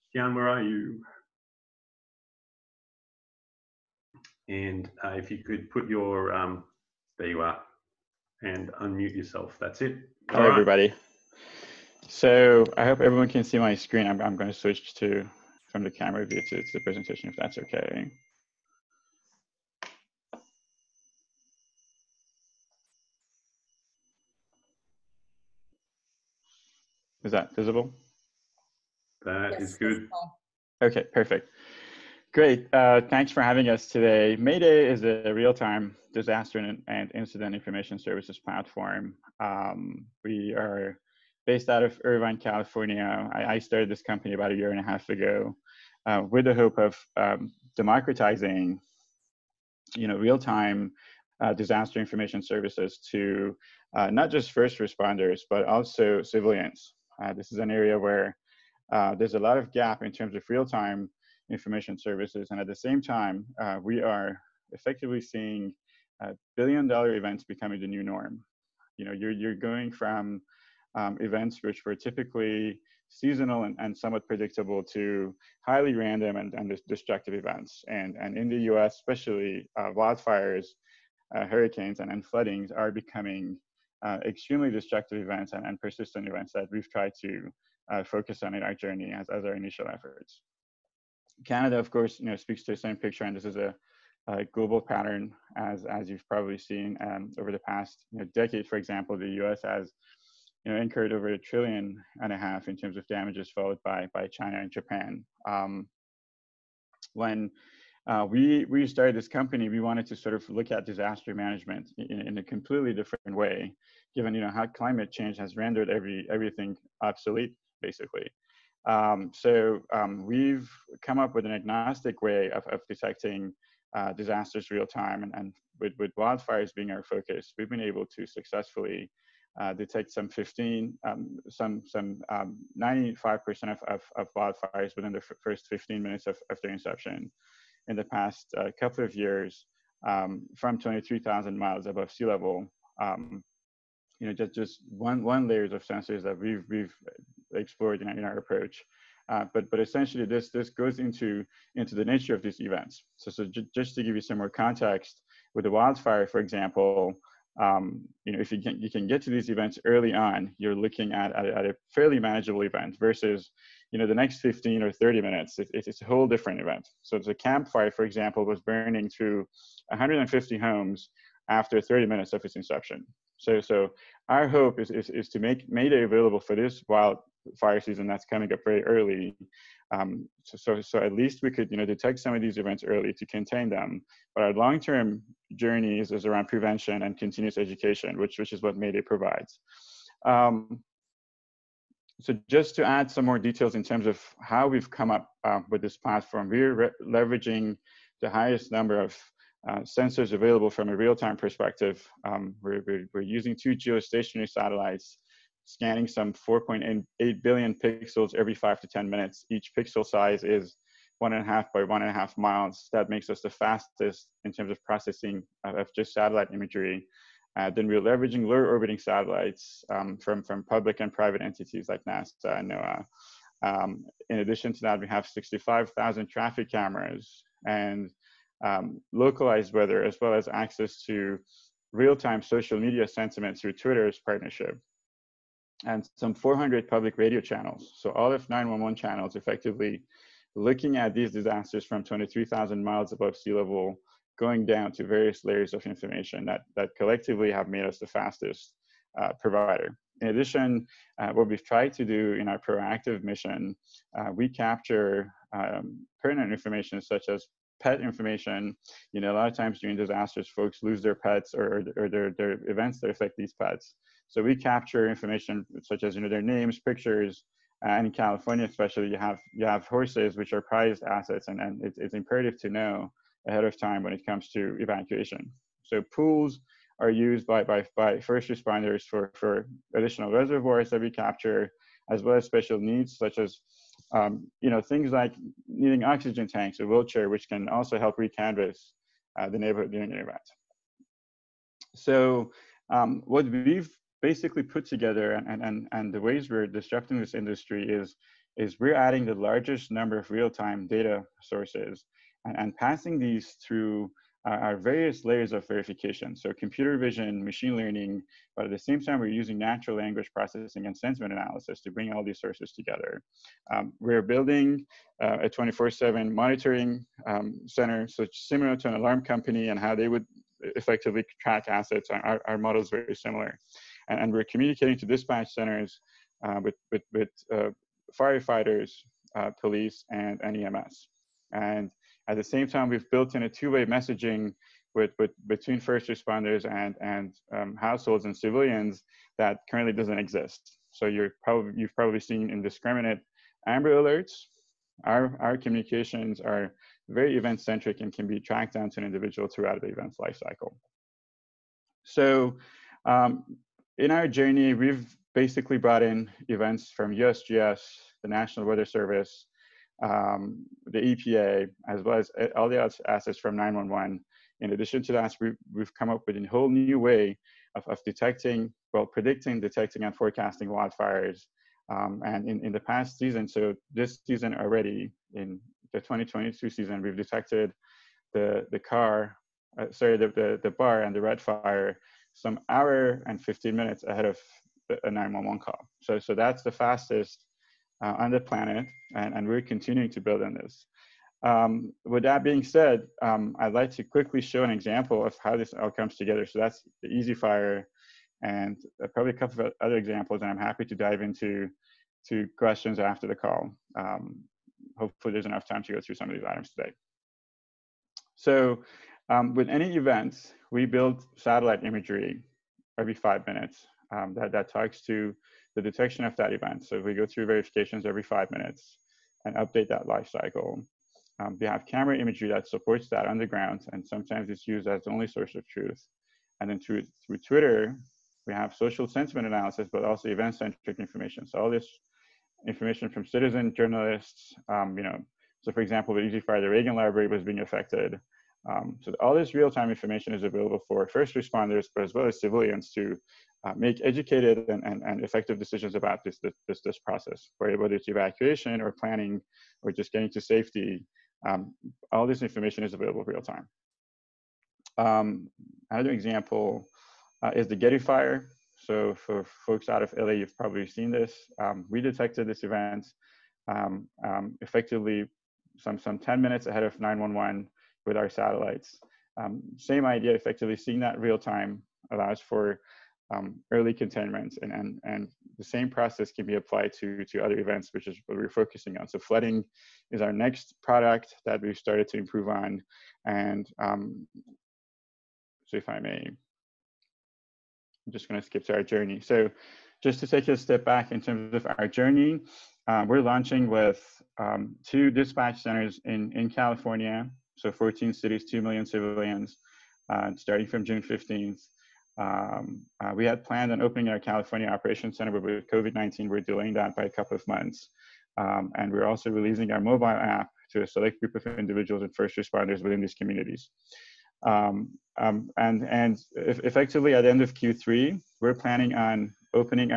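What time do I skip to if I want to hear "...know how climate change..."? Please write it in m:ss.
1:54.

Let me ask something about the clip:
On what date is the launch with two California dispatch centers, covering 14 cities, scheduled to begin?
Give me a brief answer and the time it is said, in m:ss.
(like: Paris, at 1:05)
June 15th, at 8:20.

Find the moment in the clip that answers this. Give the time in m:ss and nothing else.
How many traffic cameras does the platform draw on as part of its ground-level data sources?
3:45.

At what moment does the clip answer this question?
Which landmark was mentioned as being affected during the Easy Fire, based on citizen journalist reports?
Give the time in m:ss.
7:16.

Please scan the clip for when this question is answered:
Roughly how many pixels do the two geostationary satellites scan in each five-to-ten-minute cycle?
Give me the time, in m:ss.
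3:26.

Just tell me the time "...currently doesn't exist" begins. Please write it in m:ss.
5:39.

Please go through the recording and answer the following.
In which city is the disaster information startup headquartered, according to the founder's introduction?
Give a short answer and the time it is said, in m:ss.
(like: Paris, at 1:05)
Irvine, California, at 0:42.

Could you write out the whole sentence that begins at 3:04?
But our long-term journey is, is around prevention and continuous education, which, which is what Mayday provides.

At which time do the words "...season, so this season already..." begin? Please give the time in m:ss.
6:13.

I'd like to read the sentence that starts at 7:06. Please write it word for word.
And then through, through Twitter, we have social sentiment analysis, but also event-centric information.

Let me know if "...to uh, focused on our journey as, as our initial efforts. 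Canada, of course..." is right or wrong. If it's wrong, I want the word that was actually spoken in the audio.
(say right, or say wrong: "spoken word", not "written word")
right.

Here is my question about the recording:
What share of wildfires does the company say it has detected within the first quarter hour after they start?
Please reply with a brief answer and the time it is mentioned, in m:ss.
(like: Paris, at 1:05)
95%, at 2:12.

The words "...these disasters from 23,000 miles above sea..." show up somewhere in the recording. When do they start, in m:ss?
4:01.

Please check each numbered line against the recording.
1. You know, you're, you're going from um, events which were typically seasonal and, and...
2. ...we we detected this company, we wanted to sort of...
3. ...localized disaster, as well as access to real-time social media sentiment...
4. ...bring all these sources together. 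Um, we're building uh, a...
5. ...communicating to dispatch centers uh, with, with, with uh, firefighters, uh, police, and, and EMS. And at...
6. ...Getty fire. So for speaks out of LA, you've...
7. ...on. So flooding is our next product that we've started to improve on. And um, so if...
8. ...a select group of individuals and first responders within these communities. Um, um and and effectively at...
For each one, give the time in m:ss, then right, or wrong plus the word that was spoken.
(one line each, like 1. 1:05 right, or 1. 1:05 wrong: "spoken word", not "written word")
1. 1:08 right
2. 1:48 wrong: "started", not "detected"
3. 3:49 wrong: "weather", not "disaster"
4. 5:11 right
5. 5:24 right
6. 7:37 wrong: "folks", not "speaks"
7. 7:58 right
8. 8:30 right.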